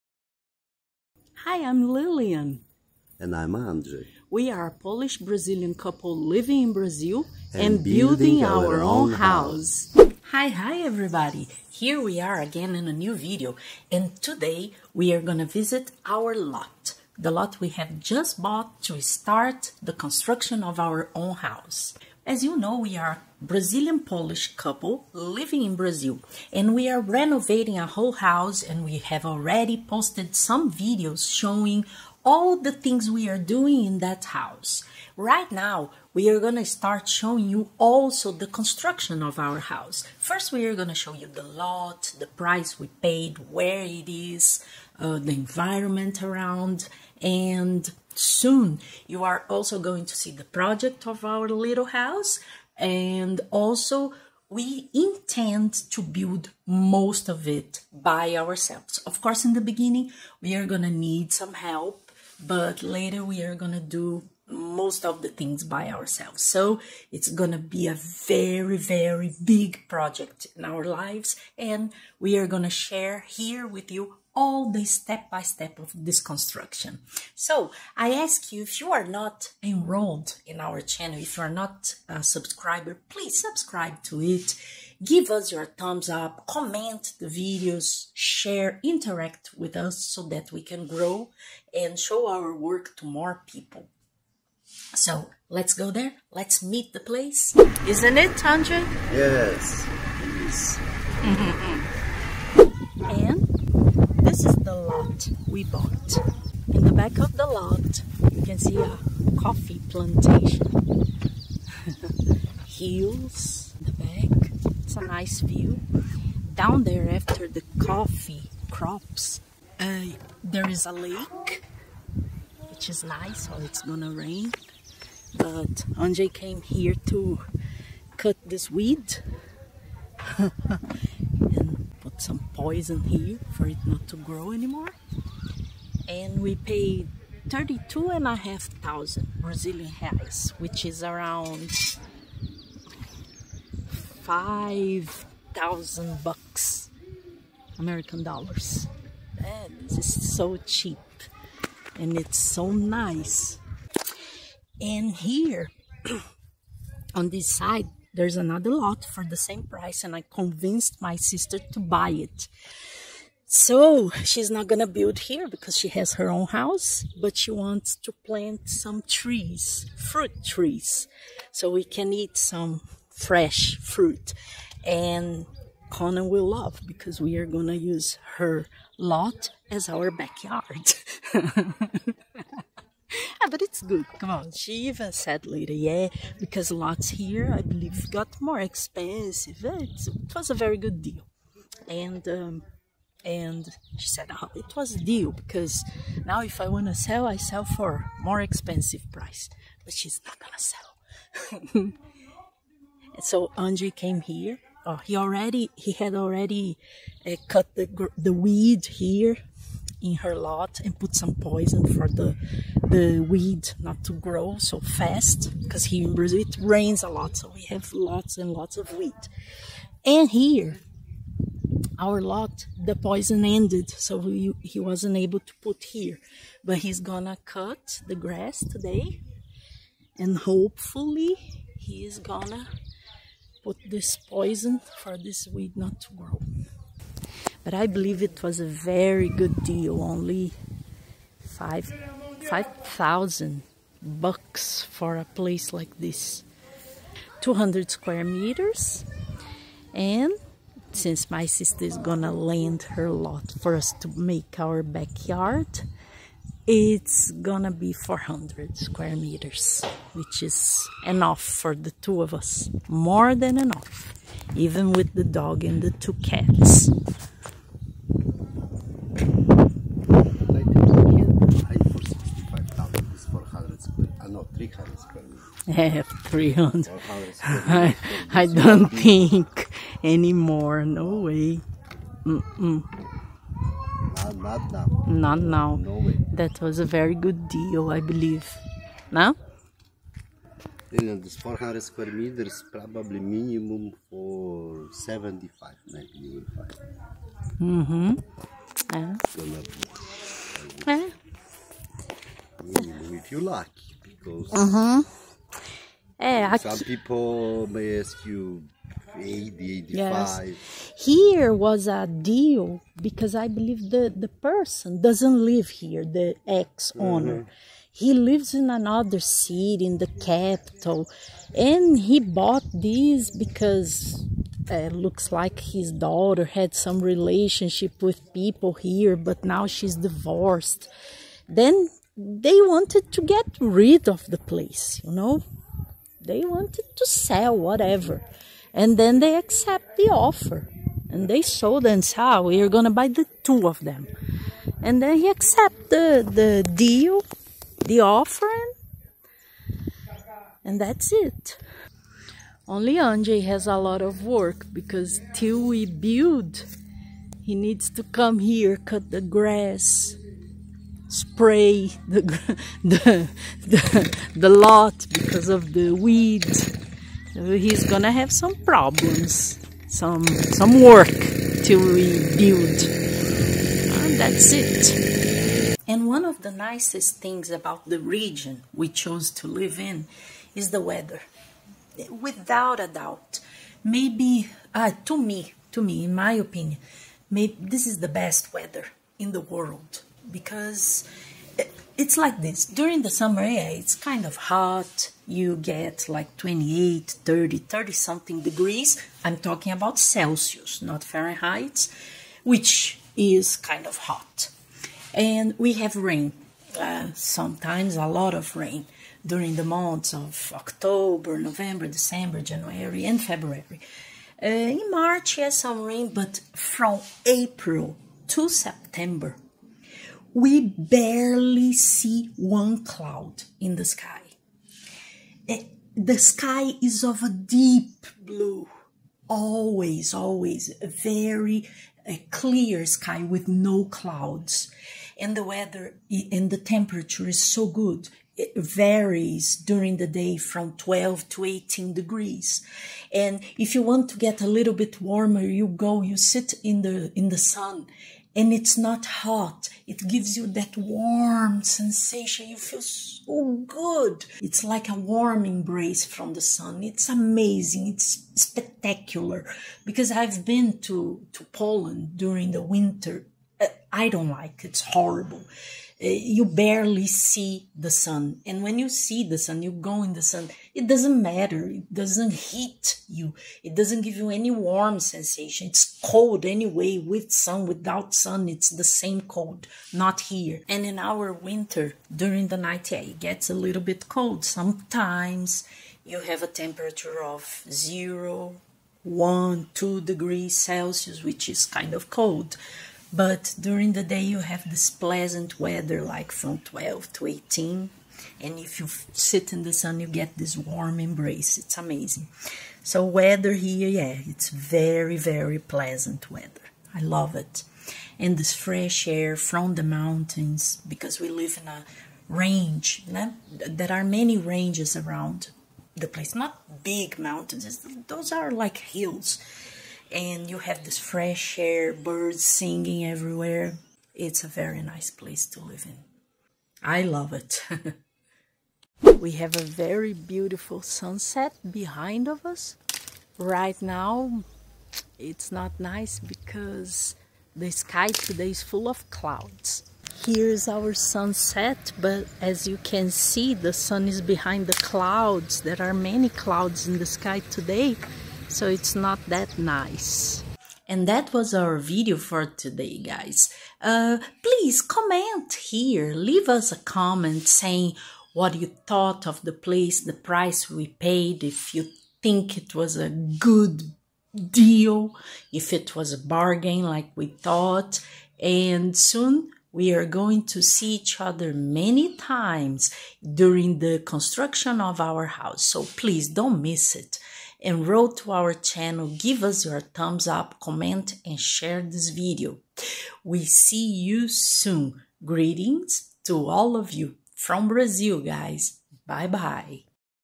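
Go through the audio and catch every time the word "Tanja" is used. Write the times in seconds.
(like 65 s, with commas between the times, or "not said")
98 s.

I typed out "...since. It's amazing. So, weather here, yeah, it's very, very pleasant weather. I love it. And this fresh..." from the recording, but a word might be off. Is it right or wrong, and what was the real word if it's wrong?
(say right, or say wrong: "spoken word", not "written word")
wrong: "embrace", not "since".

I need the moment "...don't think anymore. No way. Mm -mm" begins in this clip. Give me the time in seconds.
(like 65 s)
278 s.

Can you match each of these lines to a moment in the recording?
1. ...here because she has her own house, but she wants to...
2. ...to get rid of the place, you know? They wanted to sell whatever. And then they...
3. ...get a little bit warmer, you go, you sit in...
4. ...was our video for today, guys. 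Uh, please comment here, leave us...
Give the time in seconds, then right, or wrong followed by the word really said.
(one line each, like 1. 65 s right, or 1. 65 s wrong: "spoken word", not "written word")
1. 165 s right
2. 333 s right
3. 444 s right
4. 551 s right.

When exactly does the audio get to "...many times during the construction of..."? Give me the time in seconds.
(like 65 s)
571 s.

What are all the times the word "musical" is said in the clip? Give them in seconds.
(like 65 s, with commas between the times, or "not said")
not said.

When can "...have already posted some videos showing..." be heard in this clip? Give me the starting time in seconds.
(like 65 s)
28 s.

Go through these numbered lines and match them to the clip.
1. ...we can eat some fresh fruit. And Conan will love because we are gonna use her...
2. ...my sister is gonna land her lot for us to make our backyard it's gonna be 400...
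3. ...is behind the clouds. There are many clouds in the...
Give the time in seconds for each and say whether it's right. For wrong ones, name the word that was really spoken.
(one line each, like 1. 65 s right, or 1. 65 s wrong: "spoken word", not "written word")
1. 171 s right
2. 251 s right
3. 544 s right.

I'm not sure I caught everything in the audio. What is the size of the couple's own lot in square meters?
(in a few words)
200 square meters.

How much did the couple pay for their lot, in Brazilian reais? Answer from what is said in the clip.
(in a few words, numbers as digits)
32,500 reais.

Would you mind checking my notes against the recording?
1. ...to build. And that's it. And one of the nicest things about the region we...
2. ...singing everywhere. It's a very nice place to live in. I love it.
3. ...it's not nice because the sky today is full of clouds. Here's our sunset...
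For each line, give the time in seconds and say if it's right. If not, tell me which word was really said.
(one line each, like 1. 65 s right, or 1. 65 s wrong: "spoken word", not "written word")
1. 371 s wrong: "rebuild", not "build"
2. 522 s right
3. 535 s right.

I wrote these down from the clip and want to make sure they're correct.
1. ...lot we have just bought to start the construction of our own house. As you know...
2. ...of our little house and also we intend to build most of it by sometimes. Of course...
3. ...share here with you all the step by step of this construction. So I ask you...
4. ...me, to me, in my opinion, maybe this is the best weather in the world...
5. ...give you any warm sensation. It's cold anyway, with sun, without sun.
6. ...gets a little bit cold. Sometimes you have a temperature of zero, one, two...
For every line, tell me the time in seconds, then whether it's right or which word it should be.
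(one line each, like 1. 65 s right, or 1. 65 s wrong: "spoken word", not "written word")
1. 17 s right
2. 51 s wrong: "ourselves", not "sometimes"
3. 72 s right
4. 385 s right
5. 474 s right
6. 483 s right.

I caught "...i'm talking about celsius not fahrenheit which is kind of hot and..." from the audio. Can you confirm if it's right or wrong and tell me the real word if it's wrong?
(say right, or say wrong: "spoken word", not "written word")
right.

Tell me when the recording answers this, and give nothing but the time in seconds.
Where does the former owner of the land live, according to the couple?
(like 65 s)
319 s.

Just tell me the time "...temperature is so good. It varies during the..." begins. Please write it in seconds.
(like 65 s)
436 s.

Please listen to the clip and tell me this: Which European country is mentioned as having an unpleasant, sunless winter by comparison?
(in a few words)
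Poland.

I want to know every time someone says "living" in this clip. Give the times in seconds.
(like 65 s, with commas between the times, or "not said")
6 s, 25 s.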